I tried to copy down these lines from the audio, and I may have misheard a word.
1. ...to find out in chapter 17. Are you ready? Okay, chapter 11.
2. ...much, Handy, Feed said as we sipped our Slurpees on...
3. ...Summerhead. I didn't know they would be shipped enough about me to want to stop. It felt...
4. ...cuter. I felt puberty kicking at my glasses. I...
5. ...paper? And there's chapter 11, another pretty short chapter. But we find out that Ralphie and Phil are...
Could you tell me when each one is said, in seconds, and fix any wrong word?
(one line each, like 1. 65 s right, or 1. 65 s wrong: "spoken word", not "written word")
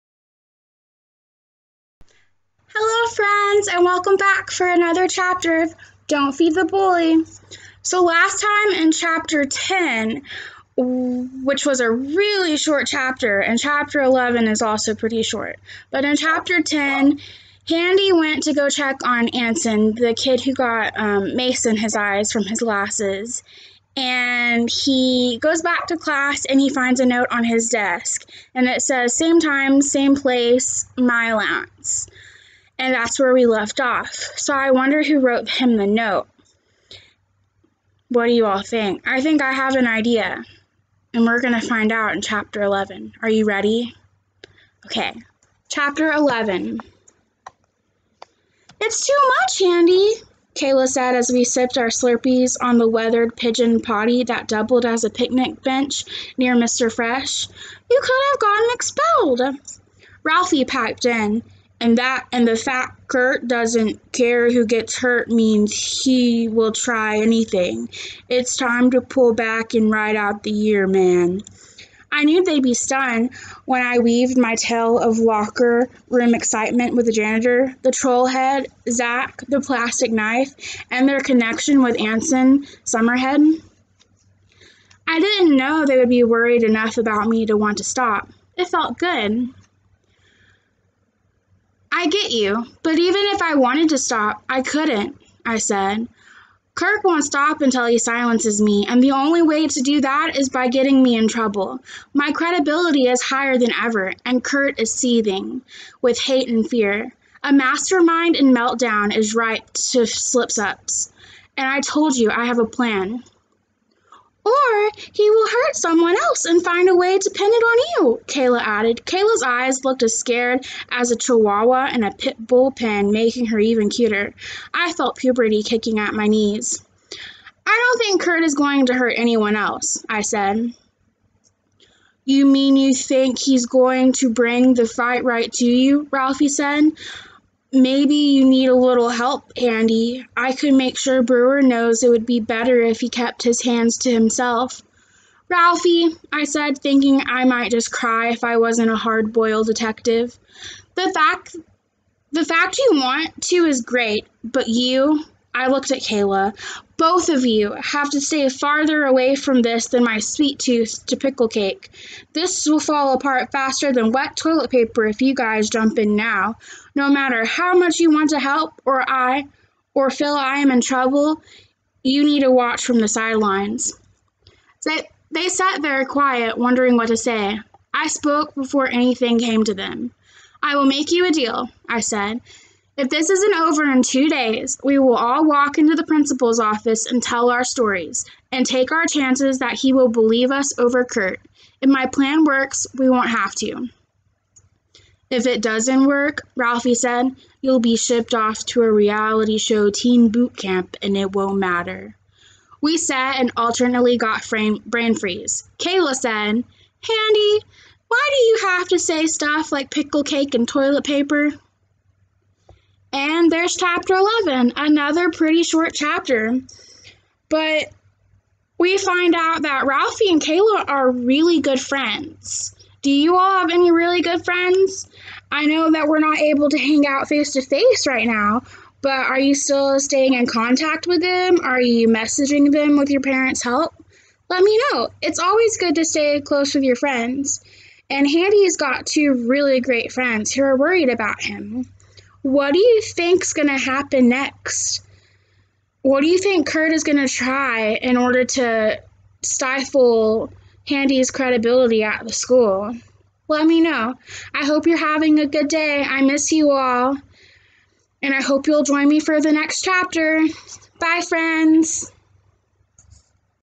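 1. 41 s wrong: "11", not "17"
2. 49 s wrong: "Kayla", not "Feed"
3. 82 s wrong: "worried", not "shipped"
4. 123 s wrong: "knees", not "glasses"
5. 211 s wrong: "Kayla", not "Phil".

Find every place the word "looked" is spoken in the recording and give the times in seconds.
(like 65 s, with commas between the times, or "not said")
119 s, 155 s.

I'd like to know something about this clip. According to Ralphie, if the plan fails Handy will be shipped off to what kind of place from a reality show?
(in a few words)
teen boot camp.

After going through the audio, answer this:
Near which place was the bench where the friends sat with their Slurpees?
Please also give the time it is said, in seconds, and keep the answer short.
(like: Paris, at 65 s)
Mr. Fresh, at 56 s.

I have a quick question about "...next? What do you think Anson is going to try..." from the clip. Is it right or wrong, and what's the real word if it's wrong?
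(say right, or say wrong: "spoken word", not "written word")
wrong: "Kurt", not "Anson".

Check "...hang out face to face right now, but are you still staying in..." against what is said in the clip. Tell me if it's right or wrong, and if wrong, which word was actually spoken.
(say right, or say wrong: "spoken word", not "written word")
right.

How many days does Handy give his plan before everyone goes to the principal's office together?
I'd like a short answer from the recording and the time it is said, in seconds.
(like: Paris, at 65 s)
2, at 184 s.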